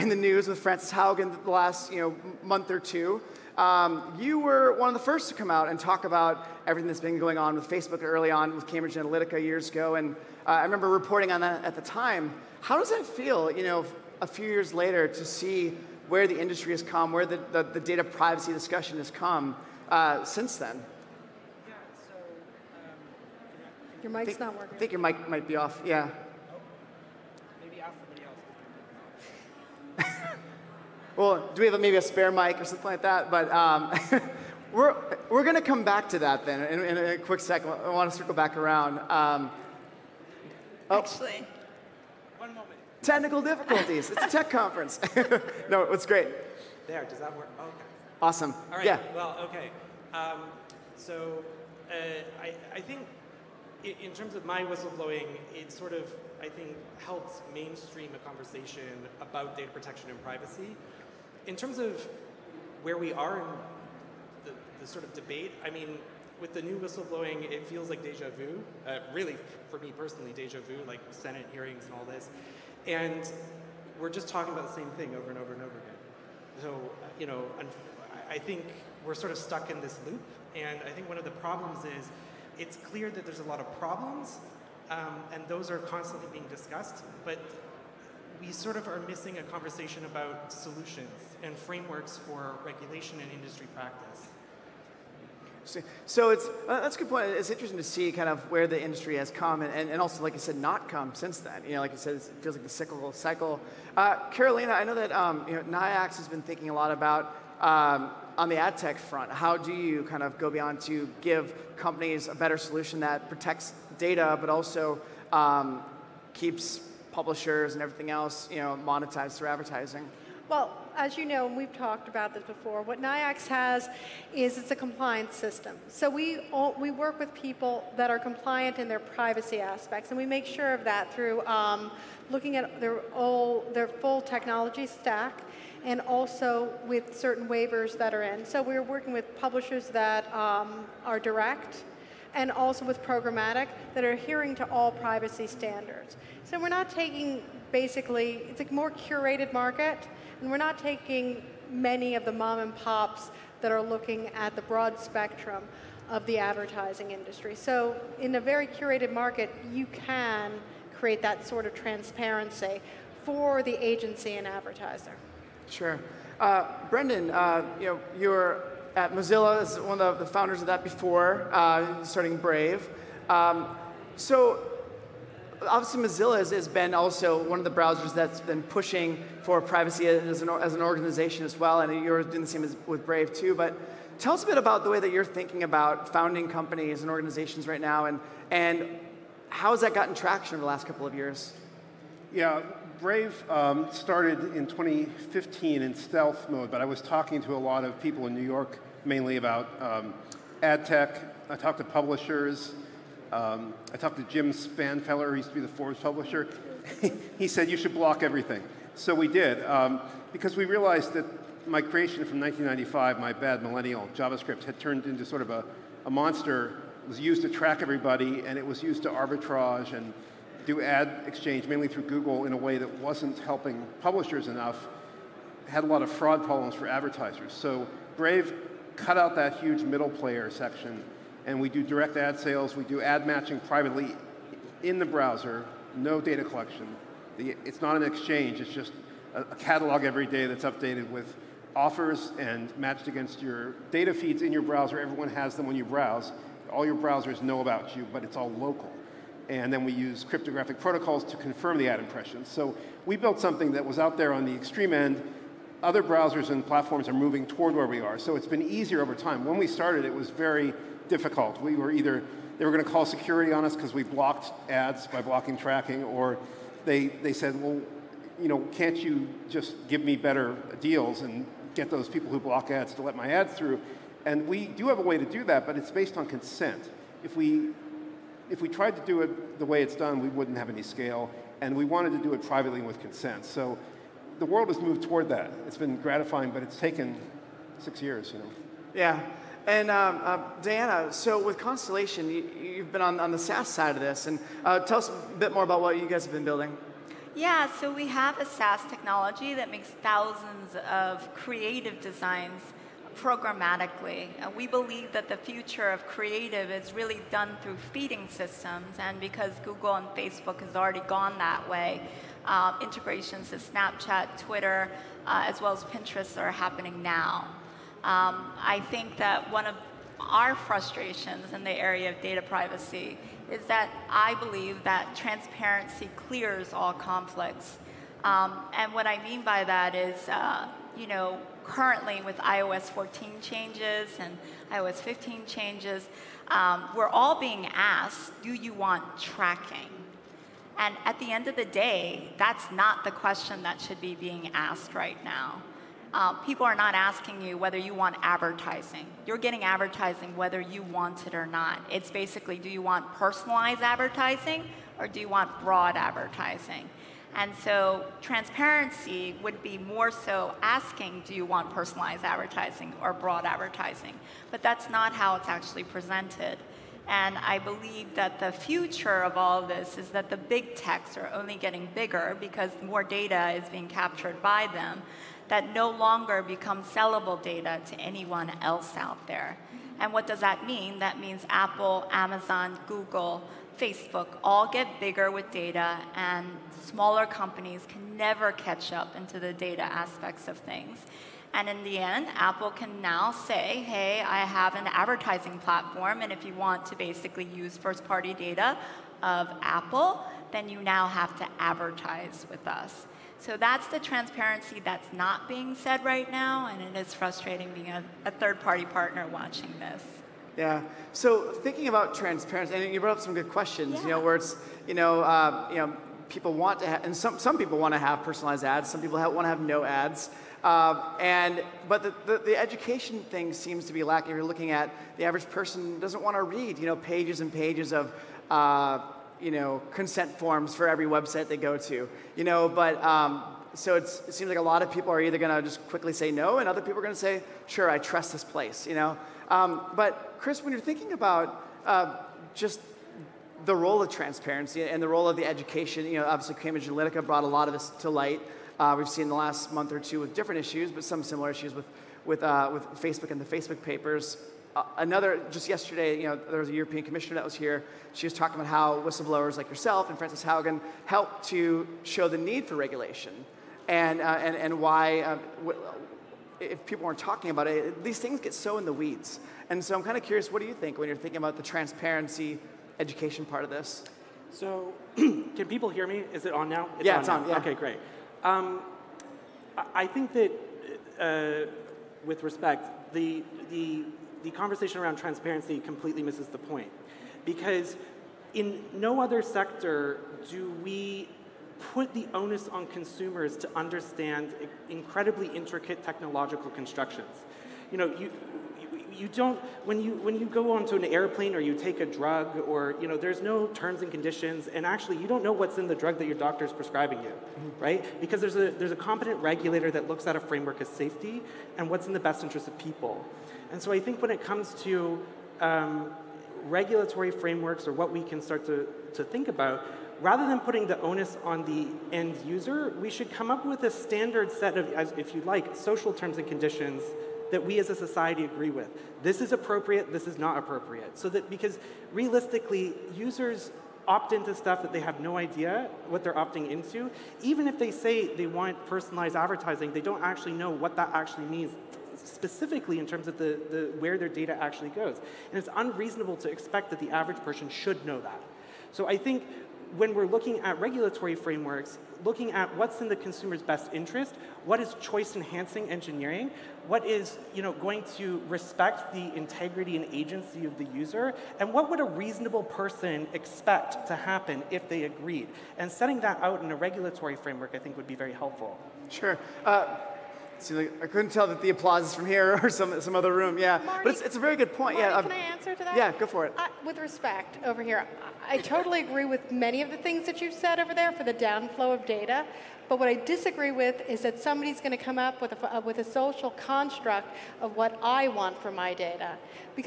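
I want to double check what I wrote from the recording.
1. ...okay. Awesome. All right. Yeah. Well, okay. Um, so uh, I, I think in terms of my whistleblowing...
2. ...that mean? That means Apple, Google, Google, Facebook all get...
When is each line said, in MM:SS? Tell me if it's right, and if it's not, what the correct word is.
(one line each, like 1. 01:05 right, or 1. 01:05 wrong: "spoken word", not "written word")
1. 00:47 right
2. 06:20 wrong: "Amazon", not "Google".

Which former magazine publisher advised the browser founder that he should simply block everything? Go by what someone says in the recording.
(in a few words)
Jim Spanfeller.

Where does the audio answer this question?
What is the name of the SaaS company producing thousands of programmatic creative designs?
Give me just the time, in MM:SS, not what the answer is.
04:51.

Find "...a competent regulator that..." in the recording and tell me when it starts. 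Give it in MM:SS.
08:28.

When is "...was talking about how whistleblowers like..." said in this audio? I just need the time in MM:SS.
07:38.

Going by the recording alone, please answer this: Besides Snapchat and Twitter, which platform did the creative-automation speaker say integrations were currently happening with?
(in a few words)
Pinterest.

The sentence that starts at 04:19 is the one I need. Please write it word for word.
When we started, it was very difficult.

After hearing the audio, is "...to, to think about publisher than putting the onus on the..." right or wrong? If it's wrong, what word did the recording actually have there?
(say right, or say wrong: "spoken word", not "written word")
wrong: "rather", not "publisher".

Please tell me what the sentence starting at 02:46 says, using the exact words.
Uh, Brendan, uh, you know, you're at Mozilla as one of the founders of that before, uh, starting Brave.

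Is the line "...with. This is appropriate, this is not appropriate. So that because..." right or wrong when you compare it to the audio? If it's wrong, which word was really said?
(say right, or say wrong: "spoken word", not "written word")
right.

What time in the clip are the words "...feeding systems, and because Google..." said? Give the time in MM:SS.
05:07.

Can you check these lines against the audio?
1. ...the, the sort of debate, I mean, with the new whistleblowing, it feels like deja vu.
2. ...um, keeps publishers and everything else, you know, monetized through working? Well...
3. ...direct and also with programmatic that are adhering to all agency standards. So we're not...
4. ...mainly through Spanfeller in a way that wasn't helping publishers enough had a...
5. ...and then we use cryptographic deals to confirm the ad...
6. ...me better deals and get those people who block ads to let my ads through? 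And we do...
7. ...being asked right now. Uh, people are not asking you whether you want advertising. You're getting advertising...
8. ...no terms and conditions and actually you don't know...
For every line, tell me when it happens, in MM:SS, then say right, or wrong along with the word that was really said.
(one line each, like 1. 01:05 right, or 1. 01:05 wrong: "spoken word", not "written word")
1. 01:04 right
2. 01:55 wrong: "advertising", not "working"
3. 02:21 wrong: "privacy", not "agency"
4. 03:41 wrong: "Google", not "Spanfeller"
5. 04:09 wrong: "protocols", not "deals"
6. 04:30 right
7. 05:44 right
8. 08:23 right.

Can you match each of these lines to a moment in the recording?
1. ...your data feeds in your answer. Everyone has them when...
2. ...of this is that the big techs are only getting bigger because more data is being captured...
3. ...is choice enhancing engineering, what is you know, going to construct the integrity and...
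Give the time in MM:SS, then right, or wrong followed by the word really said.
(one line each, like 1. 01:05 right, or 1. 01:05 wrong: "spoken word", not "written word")
1. 04:03 wrong: "browser", not "answer"
2. 06:09 right
3. 09:14 wrong: "respect", not "construct".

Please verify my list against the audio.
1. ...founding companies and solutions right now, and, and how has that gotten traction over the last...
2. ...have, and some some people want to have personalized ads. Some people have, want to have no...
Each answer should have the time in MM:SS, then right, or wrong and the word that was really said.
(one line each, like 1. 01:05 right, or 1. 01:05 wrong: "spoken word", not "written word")
1. 03:06 wrong: "organizations", not "solutions"
2. 06:56 right.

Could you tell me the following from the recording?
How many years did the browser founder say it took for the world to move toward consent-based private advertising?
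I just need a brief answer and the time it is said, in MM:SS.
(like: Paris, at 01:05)
6, at 04:47.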